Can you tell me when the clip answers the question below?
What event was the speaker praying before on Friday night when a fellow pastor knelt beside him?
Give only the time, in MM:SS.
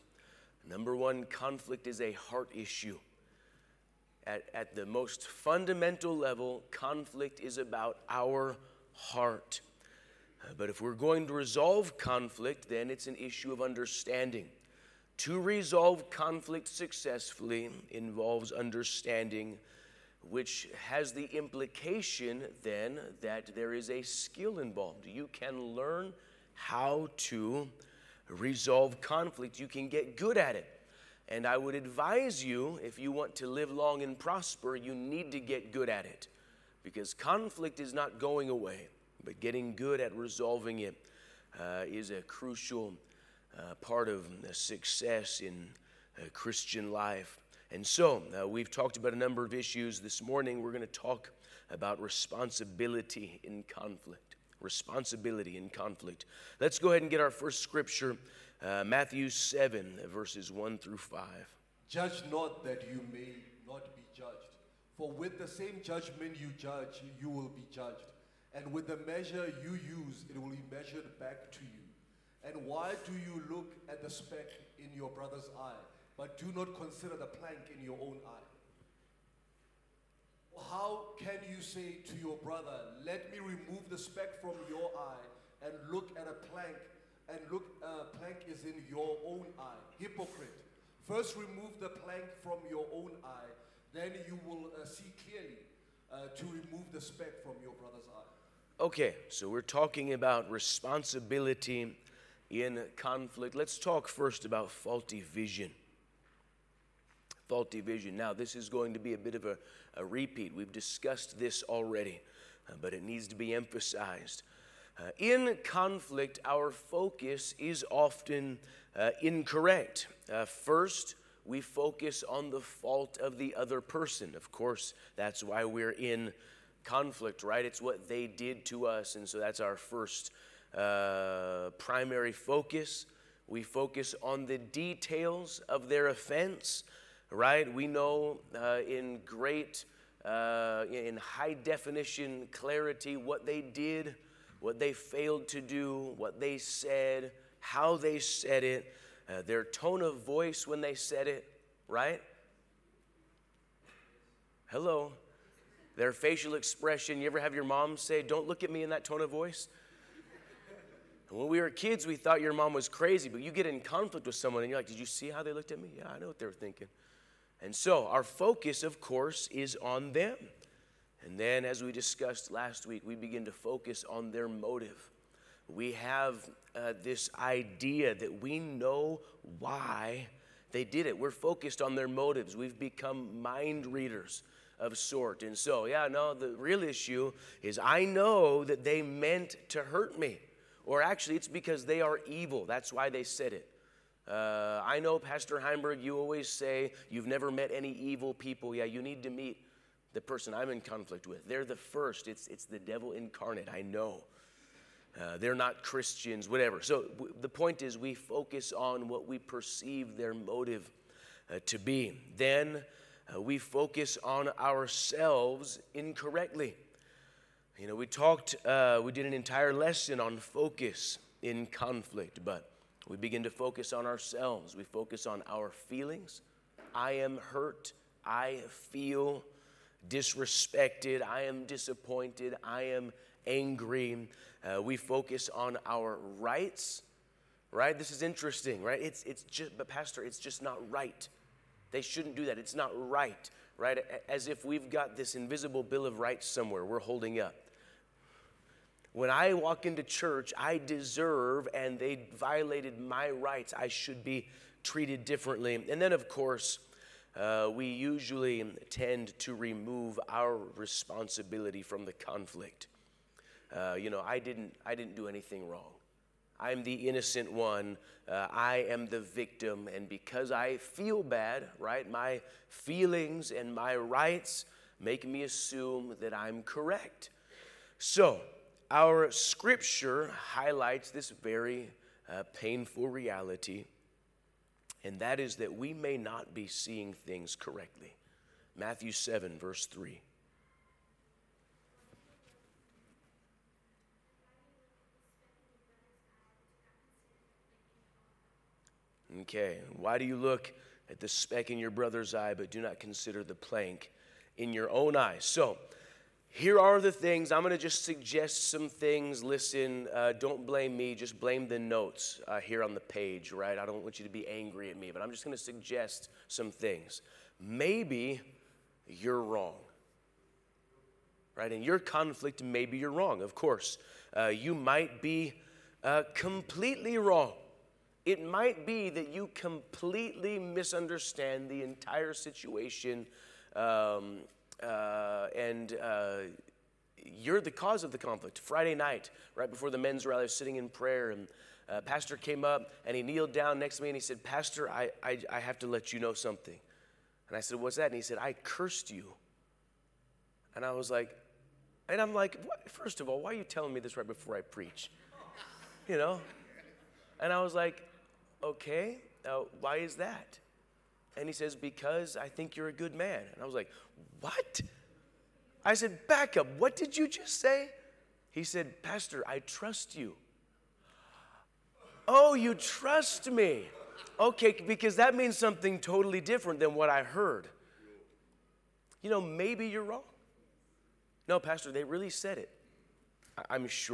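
05:39.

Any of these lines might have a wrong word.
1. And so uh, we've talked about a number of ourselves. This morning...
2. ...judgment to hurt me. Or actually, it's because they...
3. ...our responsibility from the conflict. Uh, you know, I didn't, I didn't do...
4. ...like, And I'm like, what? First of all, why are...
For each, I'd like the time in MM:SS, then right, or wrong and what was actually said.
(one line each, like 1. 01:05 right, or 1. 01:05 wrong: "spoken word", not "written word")
1. 00:47 wrong: "issues", not "ourselves"
2. 03:09 wrong: "meant", not "judgment"
3. 04:20 right
4. 05:51 right.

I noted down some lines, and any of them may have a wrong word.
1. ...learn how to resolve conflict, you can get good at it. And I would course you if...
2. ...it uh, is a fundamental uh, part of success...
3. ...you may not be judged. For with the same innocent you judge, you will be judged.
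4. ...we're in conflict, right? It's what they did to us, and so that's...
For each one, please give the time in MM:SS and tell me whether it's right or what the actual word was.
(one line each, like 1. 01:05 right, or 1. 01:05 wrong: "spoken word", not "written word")
1. 00:25 wrong: "advise", not "course"
2. 00:40 wrong: "crucial", not "fundamental"
3. 01:02 wrong: "judgment", not "innocent"
4. 02:05 right.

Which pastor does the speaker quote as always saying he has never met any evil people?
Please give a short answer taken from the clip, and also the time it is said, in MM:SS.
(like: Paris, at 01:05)
Pastor Heinberg, at 03:15.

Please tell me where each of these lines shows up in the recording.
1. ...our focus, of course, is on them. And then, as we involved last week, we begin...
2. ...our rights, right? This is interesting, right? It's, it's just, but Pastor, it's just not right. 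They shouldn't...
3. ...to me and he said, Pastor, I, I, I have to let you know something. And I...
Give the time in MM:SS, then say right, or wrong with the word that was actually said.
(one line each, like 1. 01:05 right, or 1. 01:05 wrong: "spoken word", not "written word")
1. 02:48 wrong: "discussed", not "involved"
2. 03:55 right
3. 05:43 right.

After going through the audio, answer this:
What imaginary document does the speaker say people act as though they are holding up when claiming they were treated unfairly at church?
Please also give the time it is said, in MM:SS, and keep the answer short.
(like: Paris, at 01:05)
Bill of Rights, at 04:05.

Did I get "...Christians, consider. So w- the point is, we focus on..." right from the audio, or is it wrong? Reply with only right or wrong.
wrong.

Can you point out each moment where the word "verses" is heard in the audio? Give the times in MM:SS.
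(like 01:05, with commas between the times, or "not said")
01:00, 04:49.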